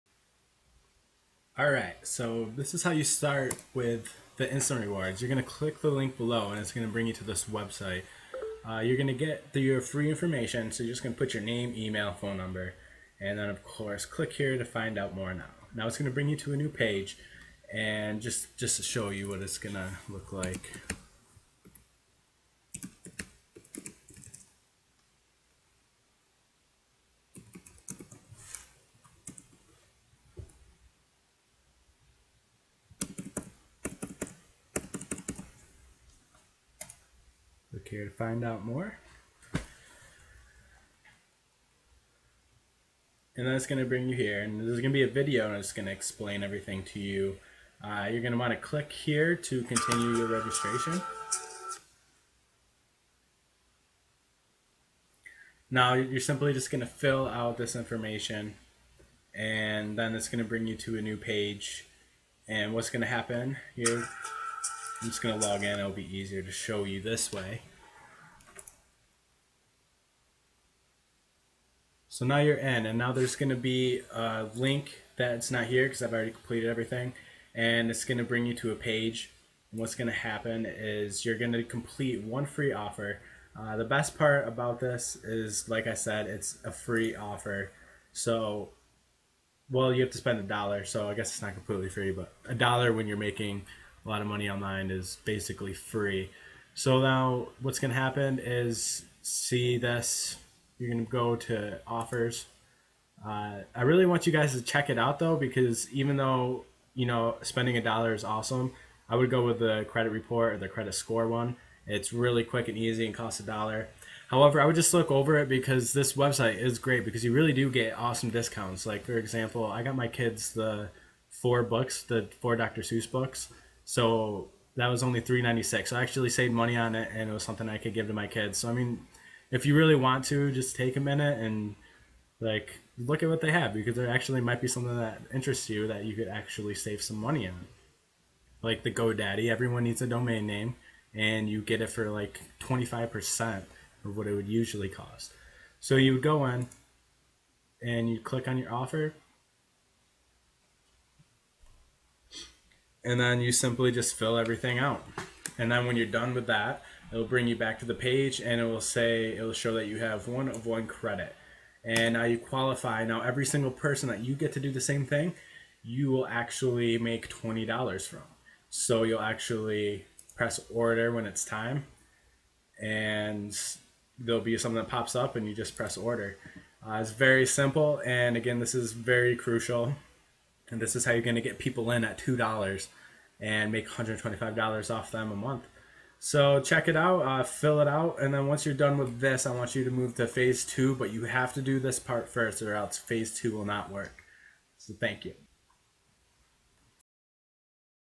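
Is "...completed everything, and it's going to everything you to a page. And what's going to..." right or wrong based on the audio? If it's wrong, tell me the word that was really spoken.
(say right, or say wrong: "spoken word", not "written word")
wrong: "bring", not "everything".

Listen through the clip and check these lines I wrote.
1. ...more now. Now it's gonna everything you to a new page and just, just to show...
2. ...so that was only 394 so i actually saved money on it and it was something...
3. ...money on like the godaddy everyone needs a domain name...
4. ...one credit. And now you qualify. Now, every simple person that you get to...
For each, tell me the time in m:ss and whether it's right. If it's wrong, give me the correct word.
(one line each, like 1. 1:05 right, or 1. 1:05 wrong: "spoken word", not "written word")
1. 0:15 wrong: "bring", not "everything"
2. 2:03 wrong: "396", not "394"
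3. 2:17 right
4. 2:40 wrong: "single", not "simple".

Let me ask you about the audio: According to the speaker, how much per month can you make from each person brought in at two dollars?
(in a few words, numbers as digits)
$125.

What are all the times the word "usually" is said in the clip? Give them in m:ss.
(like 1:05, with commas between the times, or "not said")
2:24.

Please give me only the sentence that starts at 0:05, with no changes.
You're gonna click the link below and it's gonna bring you to this website.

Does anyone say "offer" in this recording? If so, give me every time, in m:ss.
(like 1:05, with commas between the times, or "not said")
1:22, 1:27, 1:41, 2:28.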